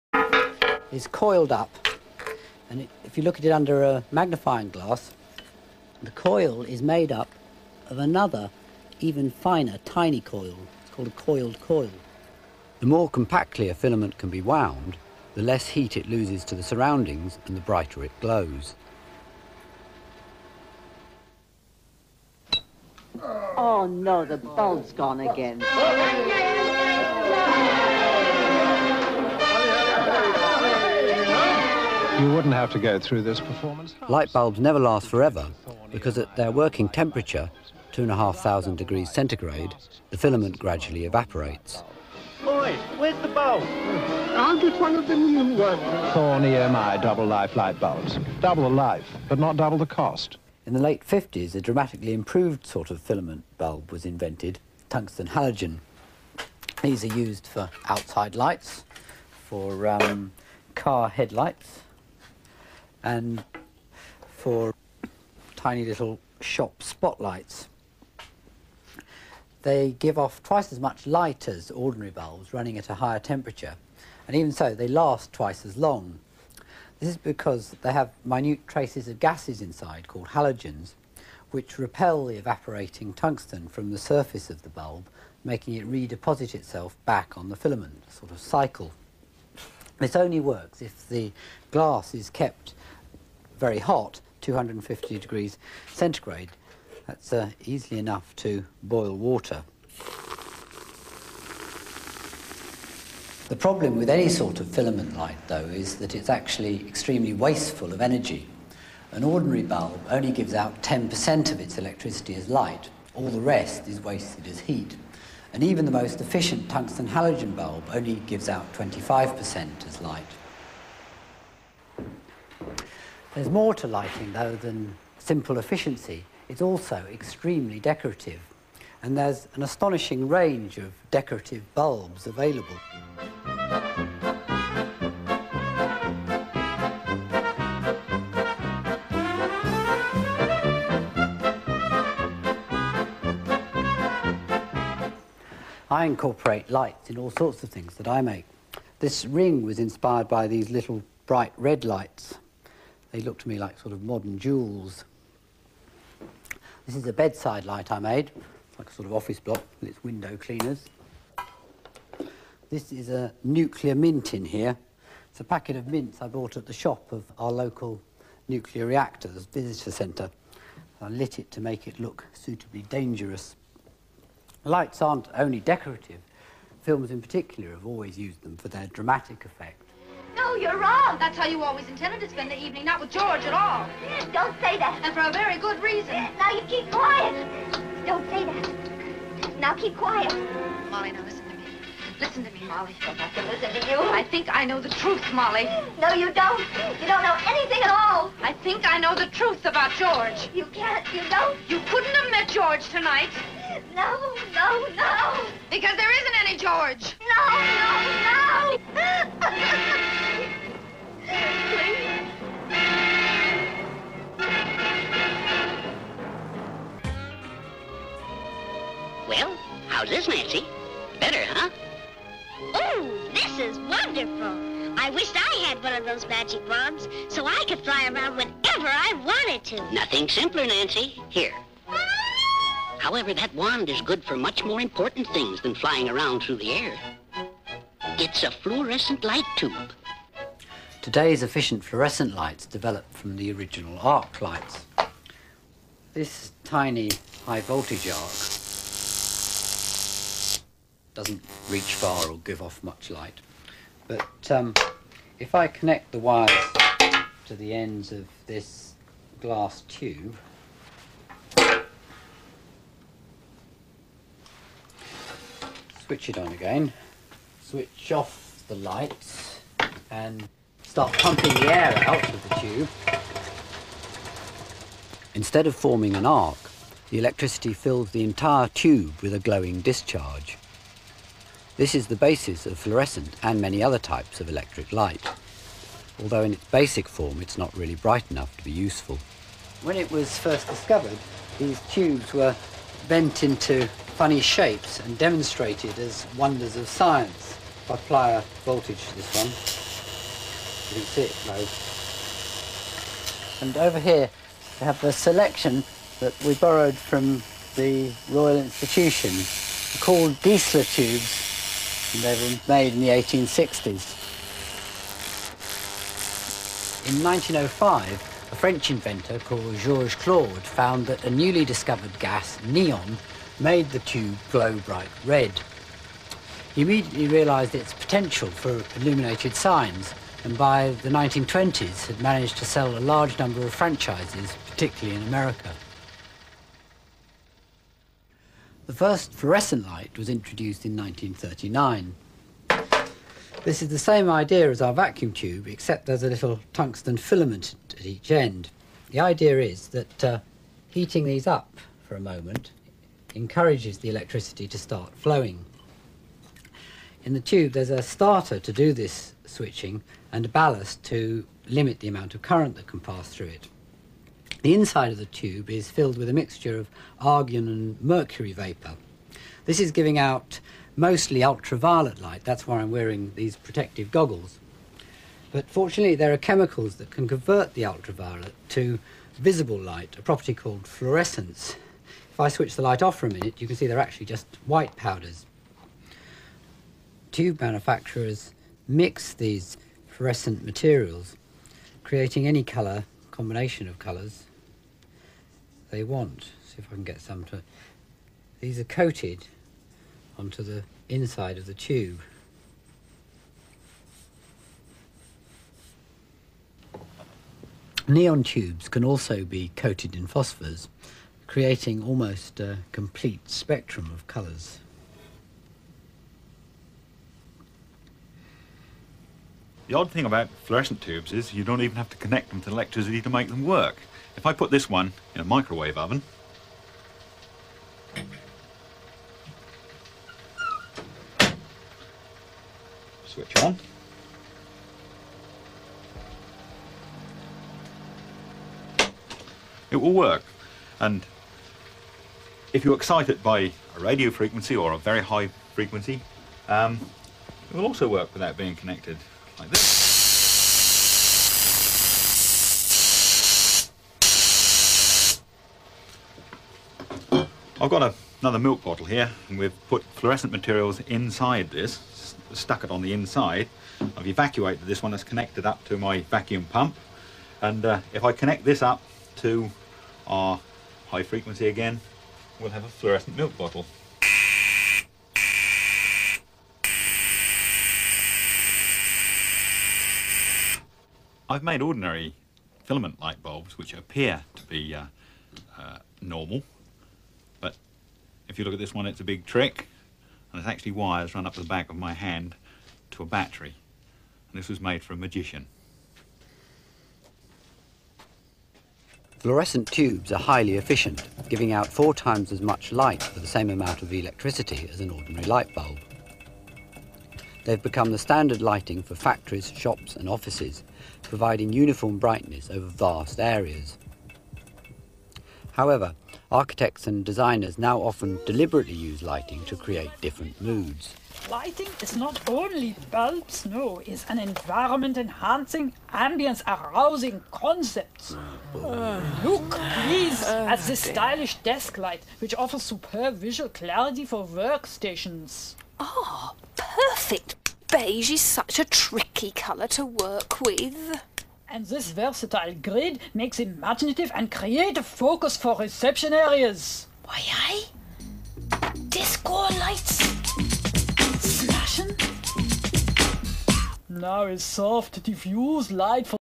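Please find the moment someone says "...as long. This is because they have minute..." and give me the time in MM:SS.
01:15.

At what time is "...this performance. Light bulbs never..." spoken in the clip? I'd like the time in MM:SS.
00:33.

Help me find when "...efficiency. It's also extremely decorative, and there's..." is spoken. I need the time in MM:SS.
02:05.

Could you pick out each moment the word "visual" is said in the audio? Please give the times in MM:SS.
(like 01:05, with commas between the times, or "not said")
08:53.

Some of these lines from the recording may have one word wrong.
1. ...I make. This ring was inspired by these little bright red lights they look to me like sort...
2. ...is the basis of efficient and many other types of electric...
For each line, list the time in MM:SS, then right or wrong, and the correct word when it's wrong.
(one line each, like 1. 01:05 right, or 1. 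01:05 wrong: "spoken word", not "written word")
1. 02:28 right
2. 04:41 wrong: "fluorescent", not "efficient".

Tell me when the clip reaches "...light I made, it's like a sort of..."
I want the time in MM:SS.
02:37.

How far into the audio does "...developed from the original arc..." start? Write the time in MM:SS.
04:02.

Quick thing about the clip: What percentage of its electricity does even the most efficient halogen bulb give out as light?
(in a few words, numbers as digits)
25%.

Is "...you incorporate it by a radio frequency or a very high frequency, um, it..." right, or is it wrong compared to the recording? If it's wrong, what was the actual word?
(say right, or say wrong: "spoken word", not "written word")
wrong: "excite", not "incorporate".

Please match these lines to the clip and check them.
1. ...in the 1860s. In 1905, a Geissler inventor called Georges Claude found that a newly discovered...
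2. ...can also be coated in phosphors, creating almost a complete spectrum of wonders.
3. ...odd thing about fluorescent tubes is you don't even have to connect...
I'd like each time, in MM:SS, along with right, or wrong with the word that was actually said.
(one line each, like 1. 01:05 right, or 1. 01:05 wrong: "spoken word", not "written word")
1. 05:12 wrong: "French", not "Geissler"
2. 06:48 wrong: "colours", not "wonders"
3. 06:59 right.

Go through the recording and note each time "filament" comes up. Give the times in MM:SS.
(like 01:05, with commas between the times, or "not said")
00:13, 00:40, 00:53, 01:27, 01:44, 05:47, 08:02.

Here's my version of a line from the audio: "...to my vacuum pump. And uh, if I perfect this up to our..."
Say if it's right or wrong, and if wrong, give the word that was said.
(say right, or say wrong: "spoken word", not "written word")
wrong: "connect", not "perfect".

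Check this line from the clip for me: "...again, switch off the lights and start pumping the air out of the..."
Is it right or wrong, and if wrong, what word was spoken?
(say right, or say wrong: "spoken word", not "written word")
right.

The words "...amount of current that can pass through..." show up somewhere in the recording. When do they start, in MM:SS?
06:02.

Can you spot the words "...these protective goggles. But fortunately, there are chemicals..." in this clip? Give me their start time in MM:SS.
06:13.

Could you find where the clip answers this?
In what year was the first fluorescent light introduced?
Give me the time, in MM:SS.
05:40.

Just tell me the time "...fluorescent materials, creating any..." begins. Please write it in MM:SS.
06:30.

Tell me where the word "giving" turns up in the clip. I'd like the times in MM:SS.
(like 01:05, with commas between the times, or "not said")
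06:09, 08:21.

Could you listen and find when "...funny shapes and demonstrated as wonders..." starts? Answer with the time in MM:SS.
04:54.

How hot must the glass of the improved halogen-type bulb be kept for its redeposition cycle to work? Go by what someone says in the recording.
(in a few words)
250 degrees centigrade.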